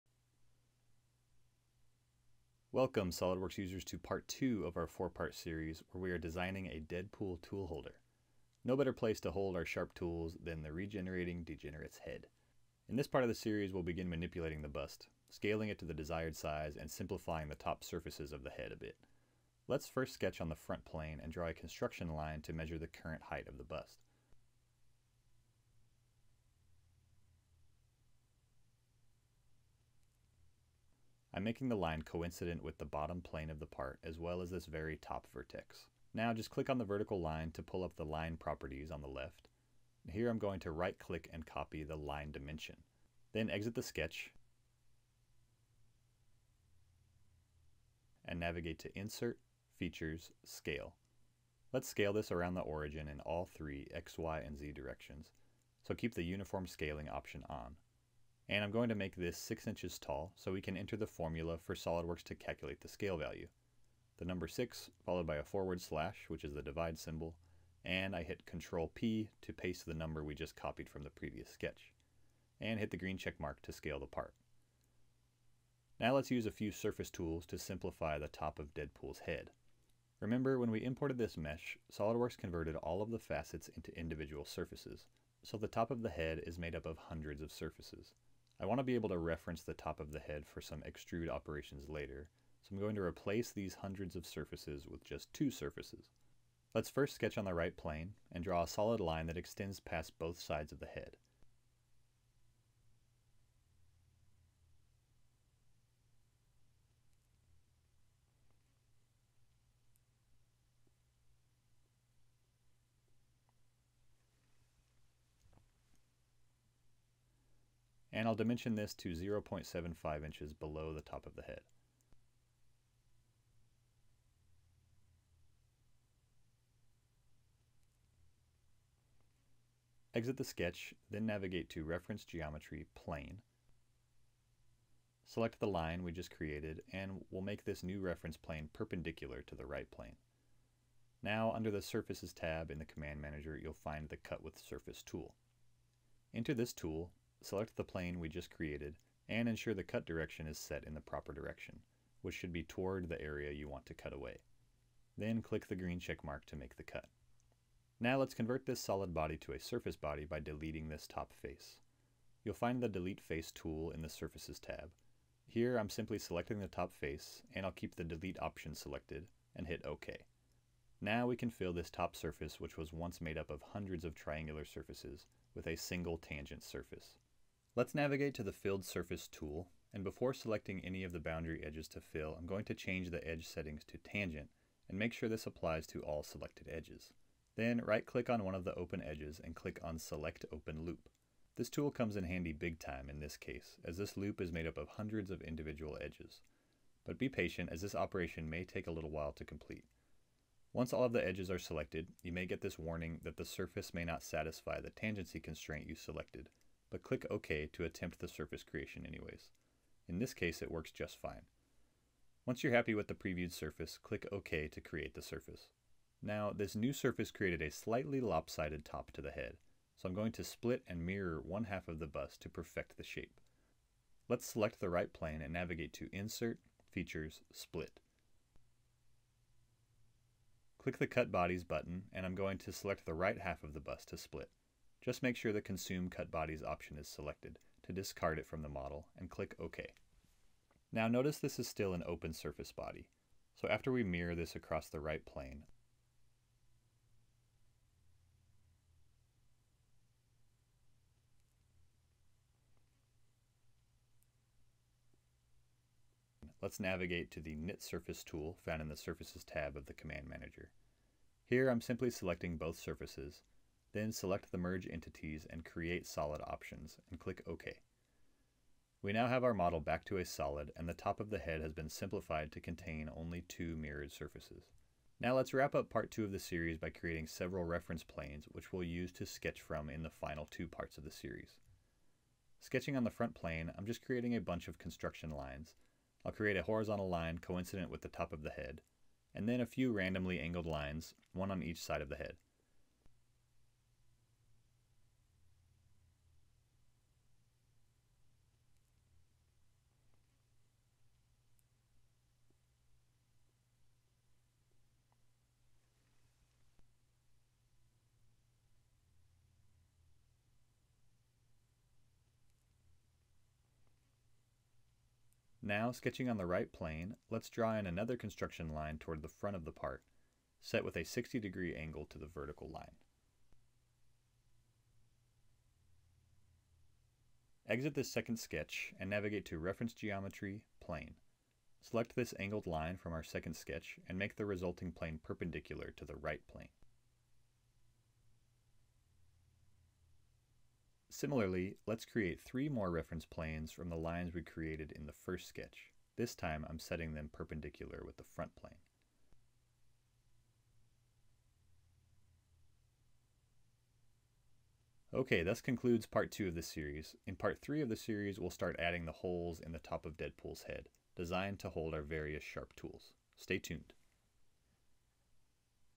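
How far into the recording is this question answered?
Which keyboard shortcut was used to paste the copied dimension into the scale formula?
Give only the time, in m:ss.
1:08.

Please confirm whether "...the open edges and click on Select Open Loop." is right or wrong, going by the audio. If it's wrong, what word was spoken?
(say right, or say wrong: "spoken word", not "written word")
right.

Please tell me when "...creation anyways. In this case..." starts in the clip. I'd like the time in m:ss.
3:28.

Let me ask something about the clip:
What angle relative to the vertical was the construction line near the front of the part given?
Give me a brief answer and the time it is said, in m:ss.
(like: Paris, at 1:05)
60 degrees, at 5:21.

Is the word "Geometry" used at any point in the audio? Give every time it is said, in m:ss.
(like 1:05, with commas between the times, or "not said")
2:12, 5:29.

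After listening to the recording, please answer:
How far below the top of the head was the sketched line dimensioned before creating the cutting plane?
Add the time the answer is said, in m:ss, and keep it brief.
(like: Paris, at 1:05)
0.75 inches, at 1:59.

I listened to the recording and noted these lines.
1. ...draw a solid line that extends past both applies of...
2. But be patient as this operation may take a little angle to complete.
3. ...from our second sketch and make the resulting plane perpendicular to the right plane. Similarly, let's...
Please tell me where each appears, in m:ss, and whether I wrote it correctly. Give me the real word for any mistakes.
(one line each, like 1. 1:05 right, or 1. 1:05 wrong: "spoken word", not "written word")
1. 1:38 wrong: "sides", not "applies"
2. 3:17 wrong: "while", not "angle"
3. 5:32 right.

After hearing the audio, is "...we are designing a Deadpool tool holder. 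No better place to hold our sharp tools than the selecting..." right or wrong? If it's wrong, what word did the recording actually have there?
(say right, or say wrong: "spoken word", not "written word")
wrong: "regenerating", not "selecting".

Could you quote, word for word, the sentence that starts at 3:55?
Just make sure the Consume Cut Bodies option is selected to discard it from the model and click OK.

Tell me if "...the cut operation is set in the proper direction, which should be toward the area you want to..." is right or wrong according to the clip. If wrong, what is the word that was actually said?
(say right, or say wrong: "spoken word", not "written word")
wrong: "direction", not "operation".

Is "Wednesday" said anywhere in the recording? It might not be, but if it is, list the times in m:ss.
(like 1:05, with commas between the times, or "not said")
not said.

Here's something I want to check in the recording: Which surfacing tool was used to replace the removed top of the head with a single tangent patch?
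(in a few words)
Filled Surface.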